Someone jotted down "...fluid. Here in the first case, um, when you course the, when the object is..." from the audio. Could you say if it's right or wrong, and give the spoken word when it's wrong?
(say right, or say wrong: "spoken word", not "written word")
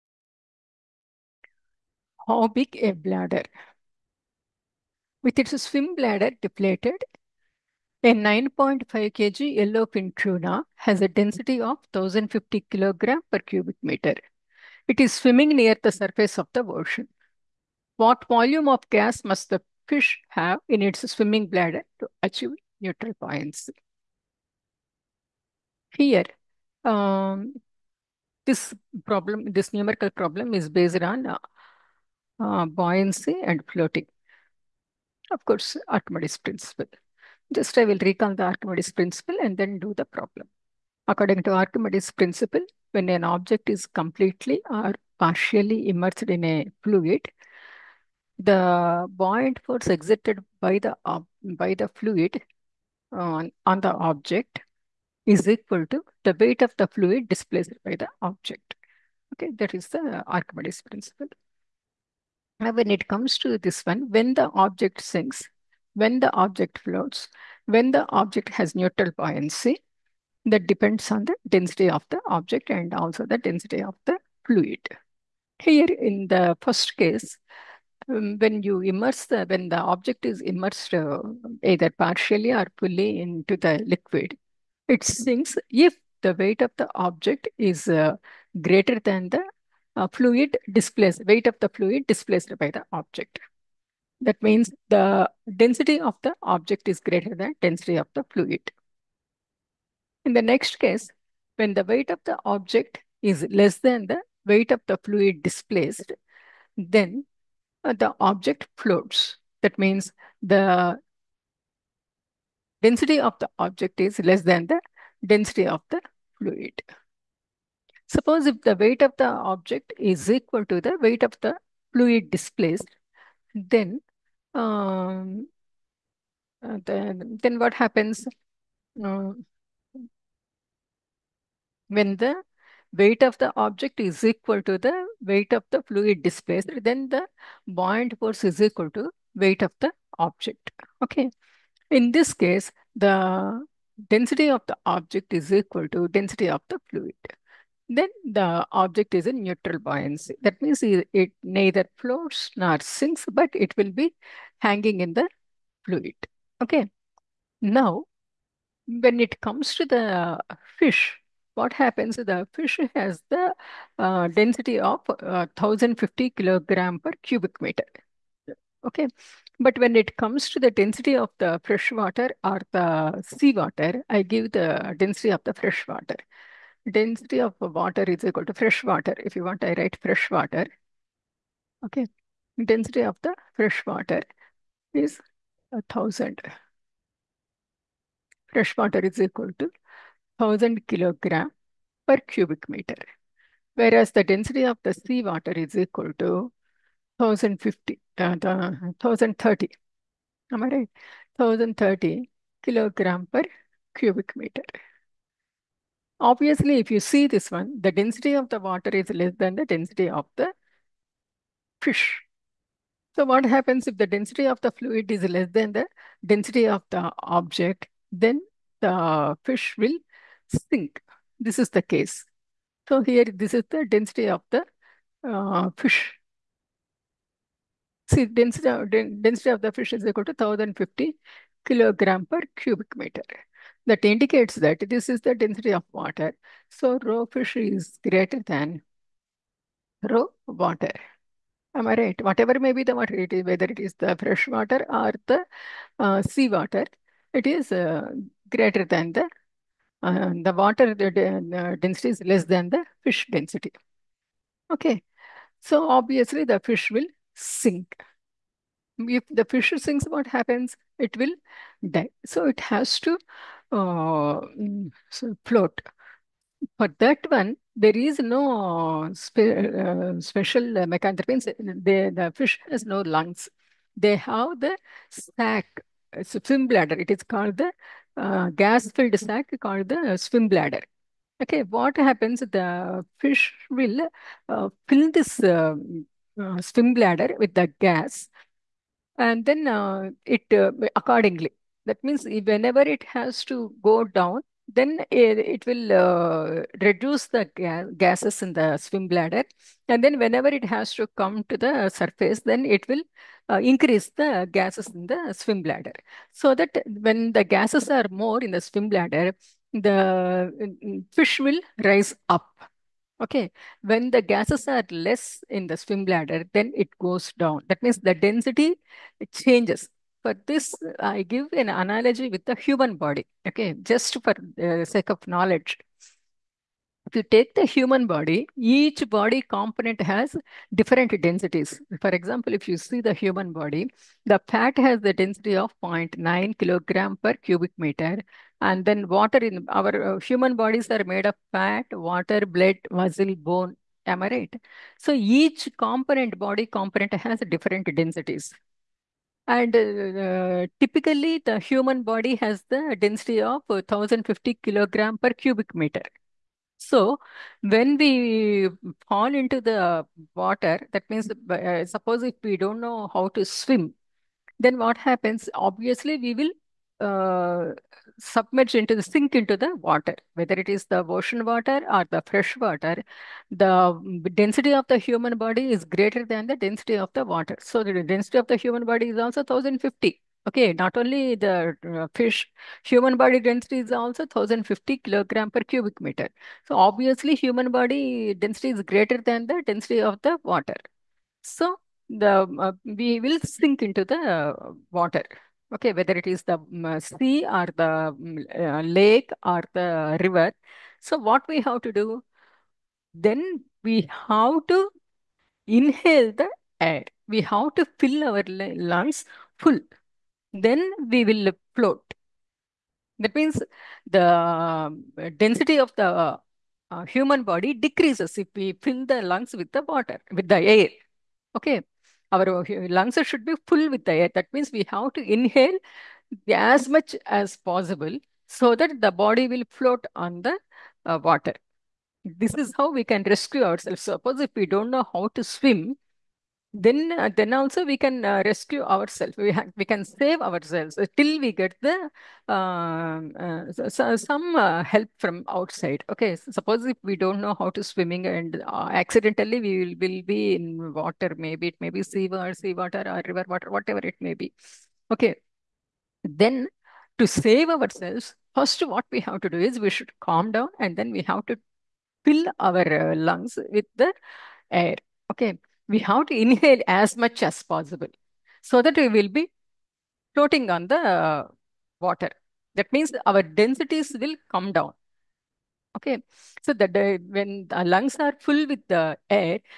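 wrong: "immerse", not "course".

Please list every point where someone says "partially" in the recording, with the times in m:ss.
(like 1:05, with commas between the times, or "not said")
0:45, 1:21.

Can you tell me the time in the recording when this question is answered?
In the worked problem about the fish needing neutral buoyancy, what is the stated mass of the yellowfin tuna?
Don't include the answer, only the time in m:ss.
0:08.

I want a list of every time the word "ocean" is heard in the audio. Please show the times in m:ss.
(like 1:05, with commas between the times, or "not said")
0:16, 6:11.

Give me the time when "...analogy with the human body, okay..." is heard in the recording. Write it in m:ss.
5:21.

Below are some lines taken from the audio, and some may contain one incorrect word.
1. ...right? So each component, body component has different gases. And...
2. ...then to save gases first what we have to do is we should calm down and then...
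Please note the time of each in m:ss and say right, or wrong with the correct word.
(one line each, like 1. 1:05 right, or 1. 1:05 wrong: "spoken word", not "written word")
1. 5:44 wrong: "densities", not "gases"
2. 7:36 wrong: "ourselves", not "gases".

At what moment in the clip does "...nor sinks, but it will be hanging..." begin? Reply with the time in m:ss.
2:32.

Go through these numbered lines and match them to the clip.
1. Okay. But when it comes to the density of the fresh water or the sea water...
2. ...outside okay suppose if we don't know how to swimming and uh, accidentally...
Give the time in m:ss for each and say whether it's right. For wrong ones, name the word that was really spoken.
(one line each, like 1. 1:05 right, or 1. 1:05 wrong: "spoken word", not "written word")
1. 2:48 right
2. 7:25 right.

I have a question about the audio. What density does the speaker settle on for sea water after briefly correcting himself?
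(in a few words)
1030 kg per cubic meter.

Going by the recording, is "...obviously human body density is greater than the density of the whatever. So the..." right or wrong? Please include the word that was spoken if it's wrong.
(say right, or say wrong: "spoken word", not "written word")
wrong: "water", not "whatever".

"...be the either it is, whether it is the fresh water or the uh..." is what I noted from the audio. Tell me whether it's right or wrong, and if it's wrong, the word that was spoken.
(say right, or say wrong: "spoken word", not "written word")
wrong: "water", not "either".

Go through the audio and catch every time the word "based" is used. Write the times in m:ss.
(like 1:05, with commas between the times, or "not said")
0:30.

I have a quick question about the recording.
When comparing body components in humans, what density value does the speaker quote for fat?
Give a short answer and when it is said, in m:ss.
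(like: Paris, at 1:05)
0.9 kg per cubic meter, at 5:35.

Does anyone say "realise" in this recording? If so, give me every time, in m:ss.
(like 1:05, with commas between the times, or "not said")
not said.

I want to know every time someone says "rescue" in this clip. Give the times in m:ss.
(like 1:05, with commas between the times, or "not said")
7:13, 7:18.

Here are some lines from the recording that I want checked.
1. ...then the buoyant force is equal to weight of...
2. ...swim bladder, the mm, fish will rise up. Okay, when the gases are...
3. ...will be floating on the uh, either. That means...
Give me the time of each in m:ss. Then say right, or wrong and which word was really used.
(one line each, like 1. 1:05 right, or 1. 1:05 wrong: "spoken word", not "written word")
1. 2:16 right
2. 5:08 right
3. 7:49 wrong: "water", not "either".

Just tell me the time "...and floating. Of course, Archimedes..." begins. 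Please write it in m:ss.
0:33.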